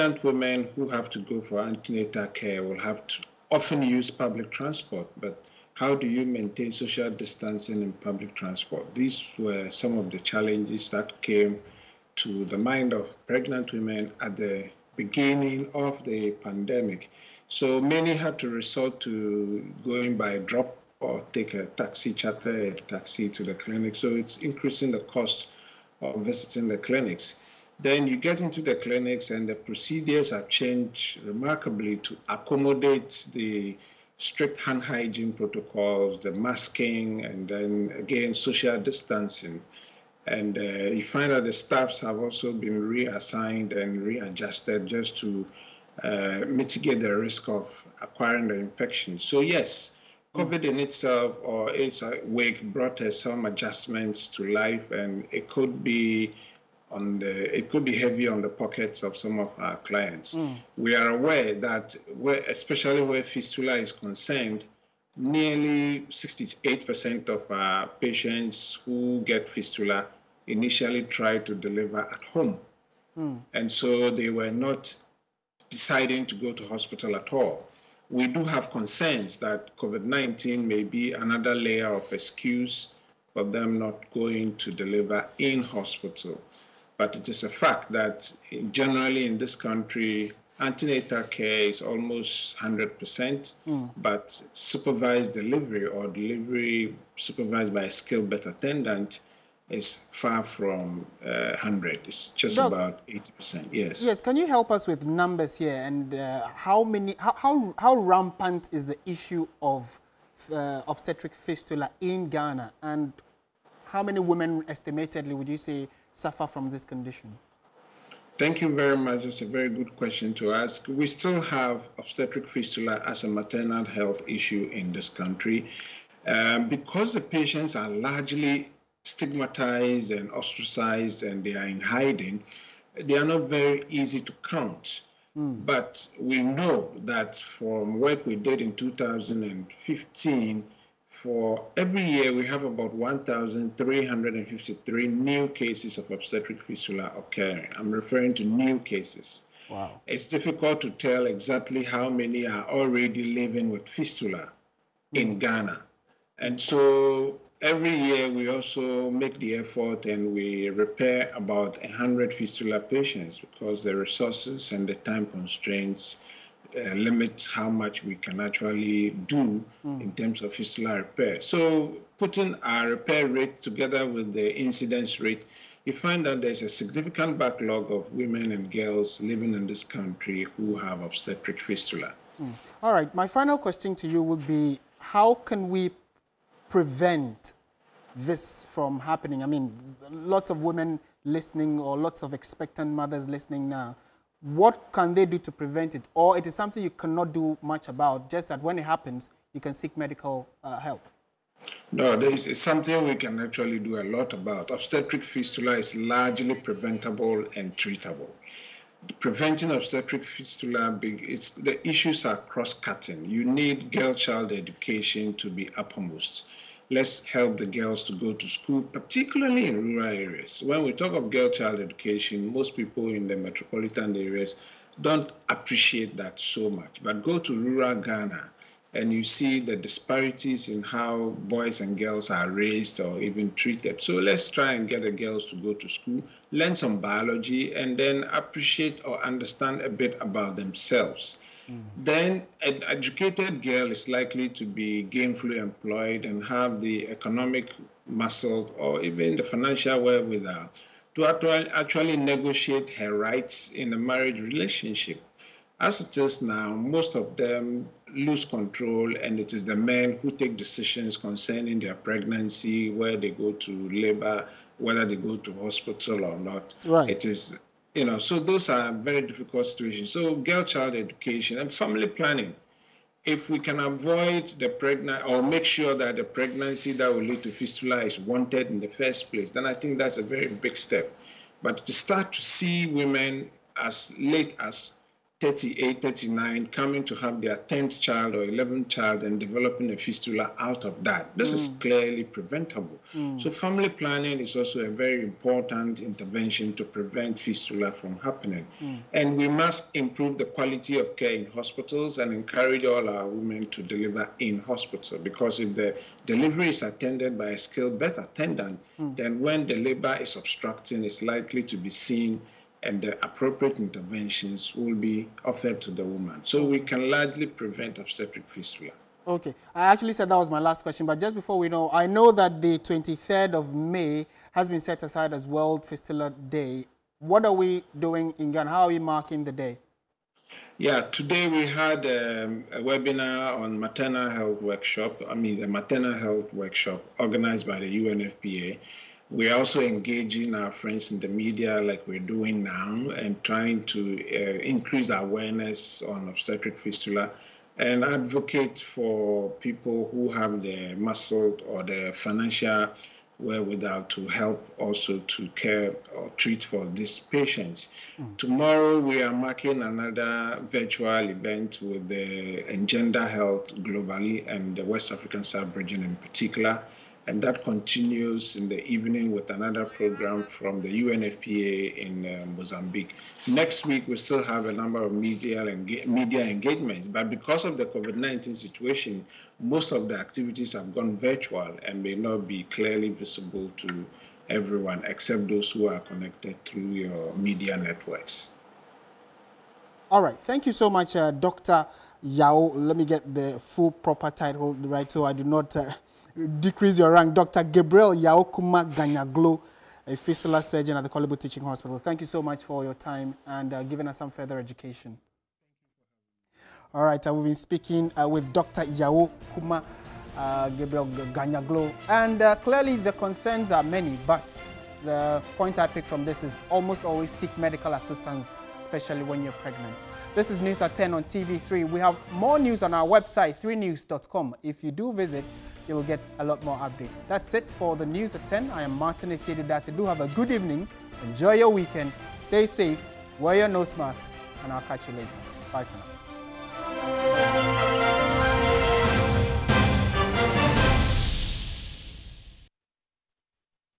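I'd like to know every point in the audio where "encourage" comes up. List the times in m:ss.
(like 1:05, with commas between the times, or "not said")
5:02.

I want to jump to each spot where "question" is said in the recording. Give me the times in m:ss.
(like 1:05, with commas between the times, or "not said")
1:59, 3:03, 5:20.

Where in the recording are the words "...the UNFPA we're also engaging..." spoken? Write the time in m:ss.
5:37.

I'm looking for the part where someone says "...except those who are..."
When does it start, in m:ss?
6:25.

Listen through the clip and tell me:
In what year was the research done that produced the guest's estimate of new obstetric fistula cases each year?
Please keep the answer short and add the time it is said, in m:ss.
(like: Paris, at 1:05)
2015, at 2:18.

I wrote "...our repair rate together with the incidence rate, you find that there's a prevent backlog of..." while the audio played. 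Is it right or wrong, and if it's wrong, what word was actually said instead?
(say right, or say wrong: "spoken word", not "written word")
wrong: "significant", not "prevent".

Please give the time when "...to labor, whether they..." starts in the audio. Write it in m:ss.
4:23.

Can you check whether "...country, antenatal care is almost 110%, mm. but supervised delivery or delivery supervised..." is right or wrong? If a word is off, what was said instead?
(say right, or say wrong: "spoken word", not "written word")
wrong: "100", not "110".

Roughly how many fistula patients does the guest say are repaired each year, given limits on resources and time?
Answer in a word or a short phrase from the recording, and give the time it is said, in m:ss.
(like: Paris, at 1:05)
100, at 2:41.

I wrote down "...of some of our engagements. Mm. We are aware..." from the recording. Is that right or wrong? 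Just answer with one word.
wrong.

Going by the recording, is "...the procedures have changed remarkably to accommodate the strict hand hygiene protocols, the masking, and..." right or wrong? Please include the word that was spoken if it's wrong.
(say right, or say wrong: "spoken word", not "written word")
right.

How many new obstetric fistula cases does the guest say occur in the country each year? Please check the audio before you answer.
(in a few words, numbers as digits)
1,353.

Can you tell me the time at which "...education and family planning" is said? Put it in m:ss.
4:30.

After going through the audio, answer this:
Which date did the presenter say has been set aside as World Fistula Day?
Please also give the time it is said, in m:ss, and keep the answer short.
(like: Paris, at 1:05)
23rd of May, at 5:22.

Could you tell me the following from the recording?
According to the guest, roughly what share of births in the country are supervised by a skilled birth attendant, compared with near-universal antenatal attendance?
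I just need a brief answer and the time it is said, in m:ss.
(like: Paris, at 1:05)
80%, at 1:42.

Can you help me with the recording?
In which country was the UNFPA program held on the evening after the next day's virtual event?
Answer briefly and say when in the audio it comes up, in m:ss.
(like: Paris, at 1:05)
Mozambique, at 6:12.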